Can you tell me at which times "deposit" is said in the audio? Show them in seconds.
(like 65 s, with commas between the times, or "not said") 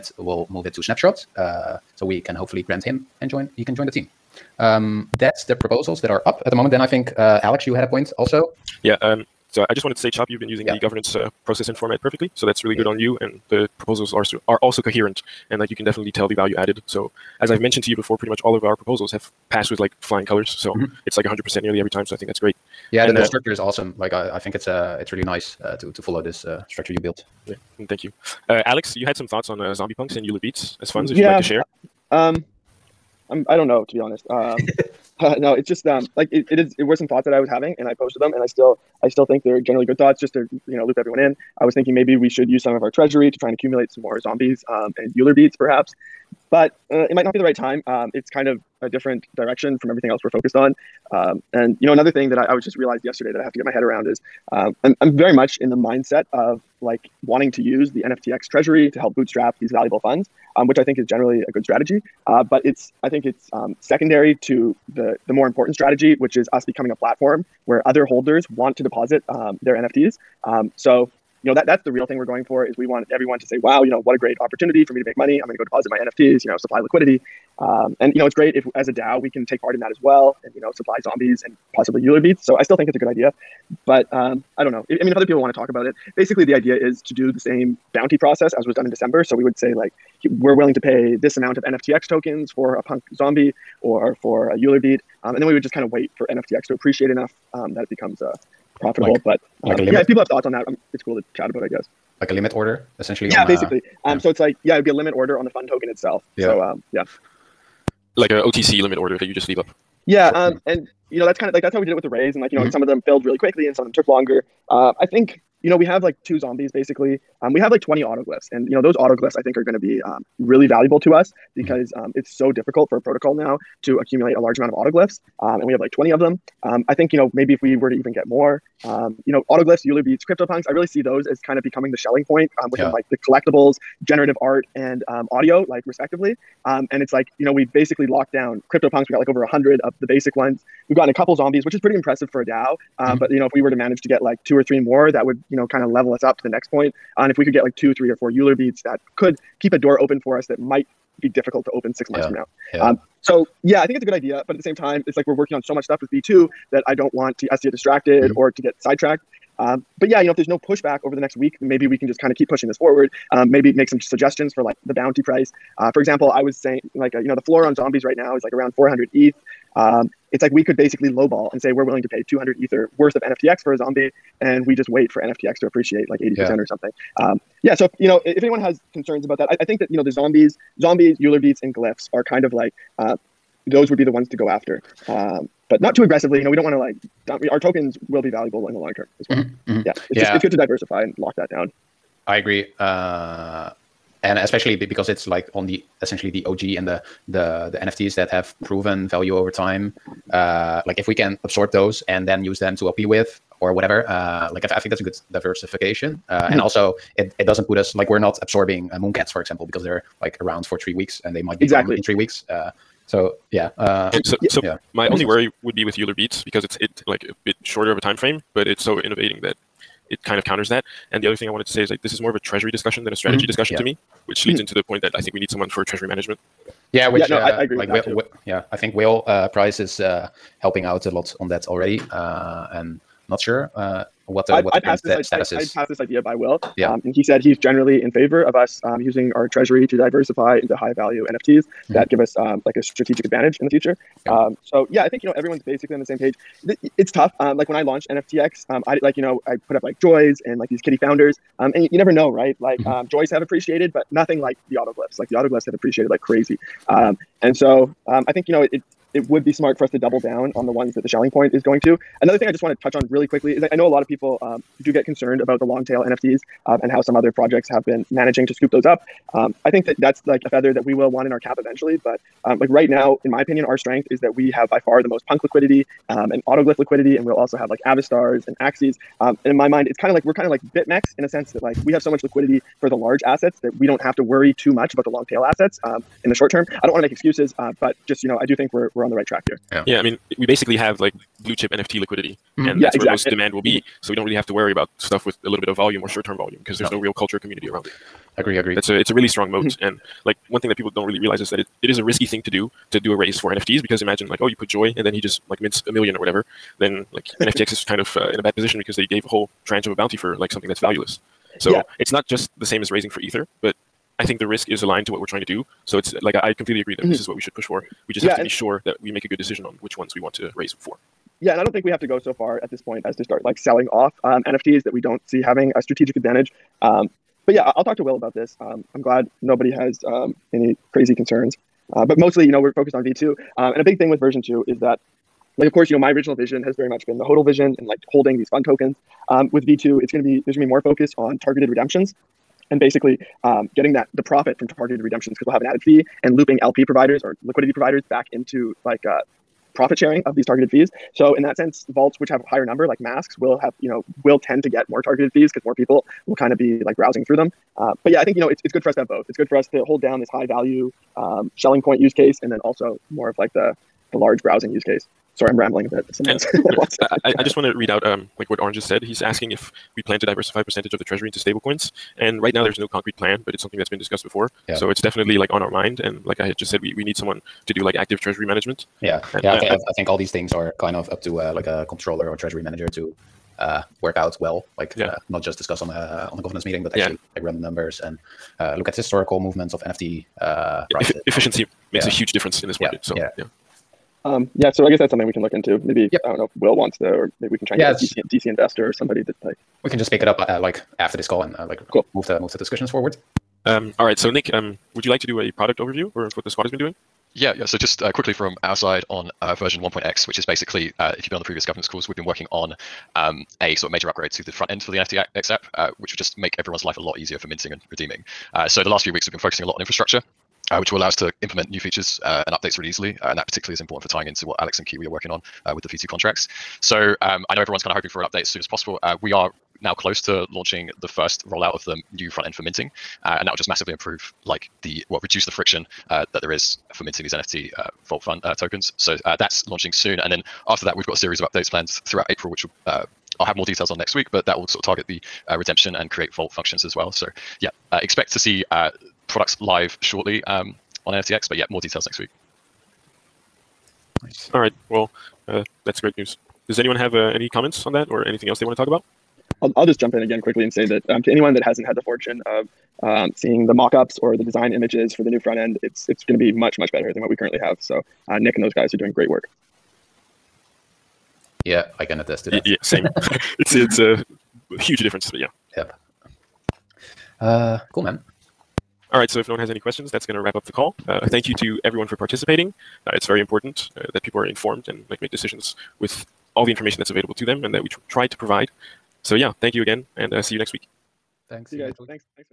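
68 s, 75 s.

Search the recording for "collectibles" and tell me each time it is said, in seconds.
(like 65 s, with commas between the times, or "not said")
133 s.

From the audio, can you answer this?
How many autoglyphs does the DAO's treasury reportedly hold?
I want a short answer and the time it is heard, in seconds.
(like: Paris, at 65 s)
20, at 117 s.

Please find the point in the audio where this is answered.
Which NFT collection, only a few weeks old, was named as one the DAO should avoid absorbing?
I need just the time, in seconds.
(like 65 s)
208 s.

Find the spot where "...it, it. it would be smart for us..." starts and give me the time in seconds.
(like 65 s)
258 s.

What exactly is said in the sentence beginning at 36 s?
It were some thoughts that I was having, and I posted them, and I still I still think they're generally good thoughts.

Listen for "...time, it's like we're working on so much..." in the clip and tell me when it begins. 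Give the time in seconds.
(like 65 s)
154 s.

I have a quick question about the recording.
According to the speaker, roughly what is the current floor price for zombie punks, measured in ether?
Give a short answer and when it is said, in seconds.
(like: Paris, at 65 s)
400 ETH, at 168 s.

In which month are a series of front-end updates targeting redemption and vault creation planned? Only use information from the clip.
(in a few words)
April.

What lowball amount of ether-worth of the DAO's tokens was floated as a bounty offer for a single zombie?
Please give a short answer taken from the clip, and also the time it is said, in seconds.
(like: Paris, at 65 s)
200 ether, at 172 s.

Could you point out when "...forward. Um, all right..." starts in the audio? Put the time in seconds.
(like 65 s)
402 s.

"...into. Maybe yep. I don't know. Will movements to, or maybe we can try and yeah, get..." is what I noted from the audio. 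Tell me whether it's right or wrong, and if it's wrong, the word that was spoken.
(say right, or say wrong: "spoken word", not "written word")
wrong: "wants", not "movements".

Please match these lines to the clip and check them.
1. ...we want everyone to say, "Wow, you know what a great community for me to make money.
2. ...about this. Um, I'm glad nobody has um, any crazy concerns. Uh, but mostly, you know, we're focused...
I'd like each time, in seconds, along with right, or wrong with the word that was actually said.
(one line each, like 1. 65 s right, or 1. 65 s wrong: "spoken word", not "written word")
1. 72 s wrong: "opportunity", not "community"
2. 328 s right.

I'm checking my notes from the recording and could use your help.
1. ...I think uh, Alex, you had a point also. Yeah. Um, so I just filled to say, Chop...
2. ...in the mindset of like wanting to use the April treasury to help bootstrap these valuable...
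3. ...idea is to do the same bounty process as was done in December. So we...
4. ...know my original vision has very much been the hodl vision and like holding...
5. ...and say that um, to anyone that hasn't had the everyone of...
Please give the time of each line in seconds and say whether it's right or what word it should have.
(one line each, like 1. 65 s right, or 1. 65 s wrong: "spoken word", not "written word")
1. 6 s wrong: "wanted", not "filled"
2. 55 s wrong: "NFTX", not "April"
3. 86 s right
4. 335 s right
5. 460 s wrong: "fortune", not "everyone".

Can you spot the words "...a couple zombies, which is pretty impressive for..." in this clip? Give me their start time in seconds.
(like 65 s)
141 s.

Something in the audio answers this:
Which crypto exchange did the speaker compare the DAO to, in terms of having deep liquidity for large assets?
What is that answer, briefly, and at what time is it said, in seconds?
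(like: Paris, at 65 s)
BitMEX, at 280 s.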